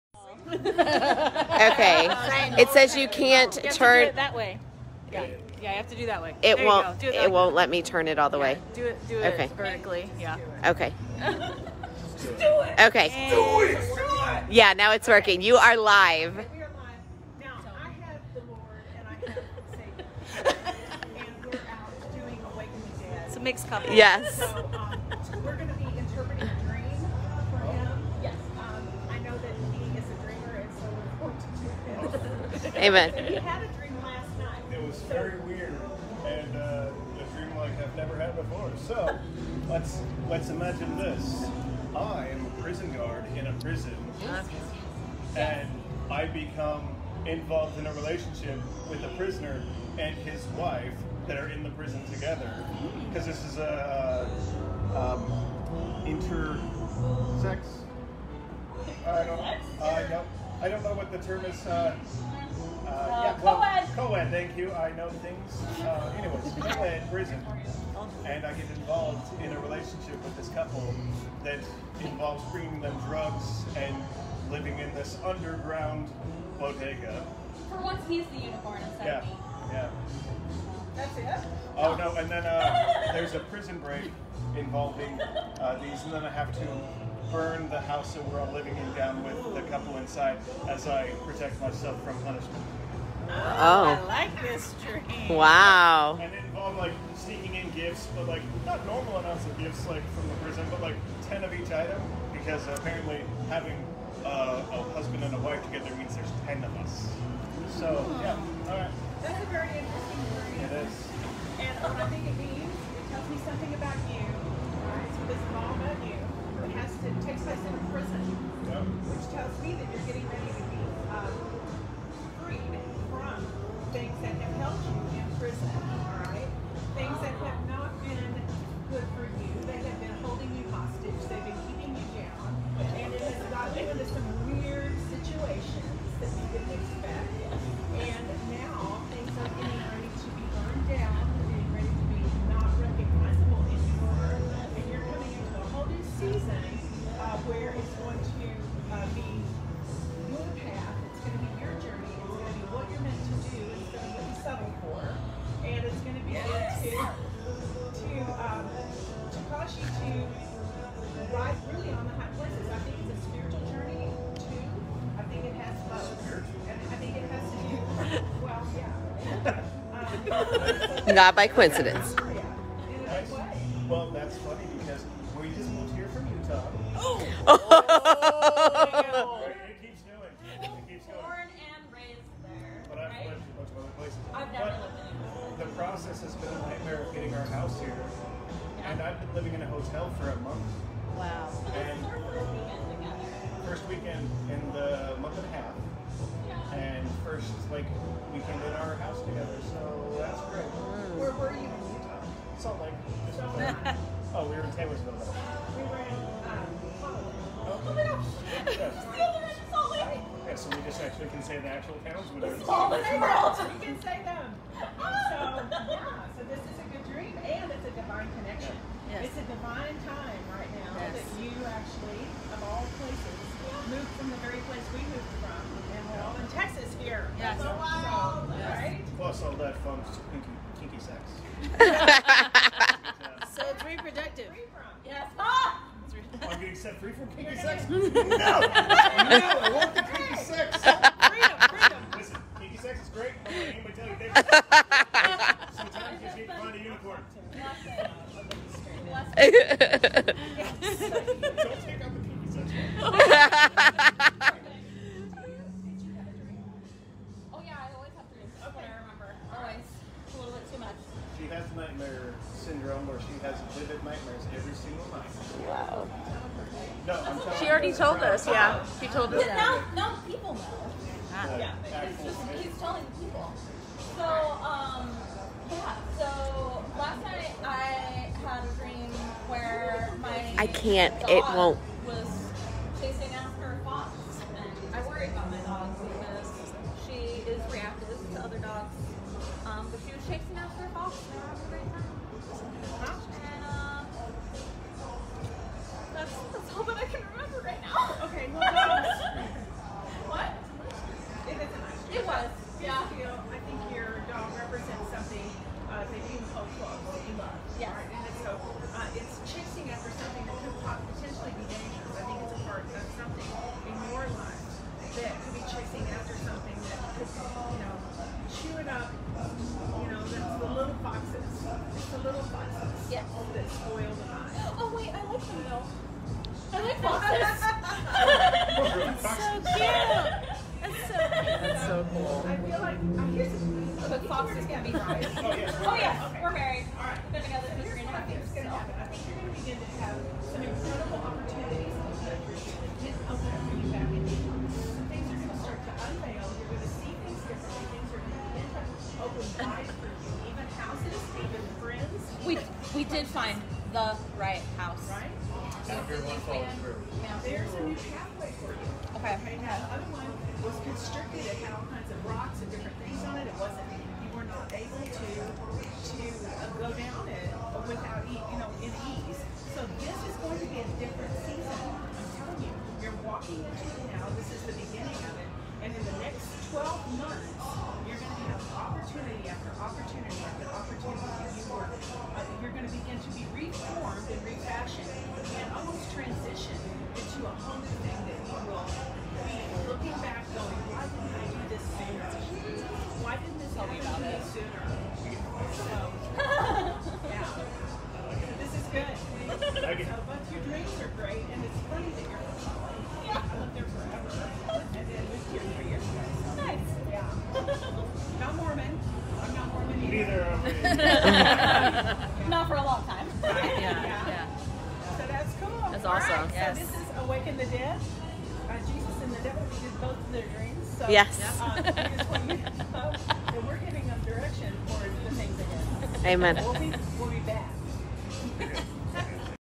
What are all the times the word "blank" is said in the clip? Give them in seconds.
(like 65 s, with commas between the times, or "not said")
not said.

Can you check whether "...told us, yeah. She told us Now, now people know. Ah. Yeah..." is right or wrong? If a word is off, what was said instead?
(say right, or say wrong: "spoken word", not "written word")
right.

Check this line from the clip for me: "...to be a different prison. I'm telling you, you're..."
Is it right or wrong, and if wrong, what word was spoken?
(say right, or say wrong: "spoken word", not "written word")
wrong: "season", not "prison".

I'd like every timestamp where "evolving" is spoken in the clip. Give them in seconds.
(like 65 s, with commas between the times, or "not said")
not said.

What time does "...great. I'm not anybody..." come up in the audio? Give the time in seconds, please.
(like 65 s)
243 s.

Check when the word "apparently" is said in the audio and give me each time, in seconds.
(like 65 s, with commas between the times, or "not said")
102 s.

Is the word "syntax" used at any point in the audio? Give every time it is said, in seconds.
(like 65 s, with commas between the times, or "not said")
not said.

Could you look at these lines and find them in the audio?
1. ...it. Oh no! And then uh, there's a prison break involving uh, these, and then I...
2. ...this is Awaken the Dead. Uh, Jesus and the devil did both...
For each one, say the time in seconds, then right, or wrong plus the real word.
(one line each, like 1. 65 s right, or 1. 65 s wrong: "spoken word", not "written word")
1. 81 s right
2. 416 s right.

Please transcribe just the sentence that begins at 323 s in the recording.
Oh wait, I like them though.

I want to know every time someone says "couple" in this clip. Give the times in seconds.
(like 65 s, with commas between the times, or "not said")
23 s, 70 s, 89 s.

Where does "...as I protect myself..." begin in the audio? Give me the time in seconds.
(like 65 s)
90 s.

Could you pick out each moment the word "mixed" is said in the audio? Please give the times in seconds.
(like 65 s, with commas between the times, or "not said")
23 s.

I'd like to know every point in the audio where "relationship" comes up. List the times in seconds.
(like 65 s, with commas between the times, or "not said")
47 s, 69 s.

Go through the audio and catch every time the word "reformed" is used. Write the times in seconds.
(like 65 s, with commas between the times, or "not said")
383 s.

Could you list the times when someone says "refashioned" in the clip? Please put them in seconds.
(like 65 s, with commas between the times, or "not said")
384 s.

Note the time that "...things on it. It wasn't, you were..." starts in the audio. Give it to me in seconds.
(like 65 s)
363 s.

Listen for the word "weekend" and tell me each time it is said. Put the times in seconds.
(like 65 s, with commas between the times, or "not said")
193 s, 198 s.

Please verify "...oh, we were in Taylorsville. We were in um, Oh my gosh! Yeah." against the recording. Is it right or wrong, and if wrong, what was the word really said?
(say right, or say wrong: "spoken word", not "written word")
right.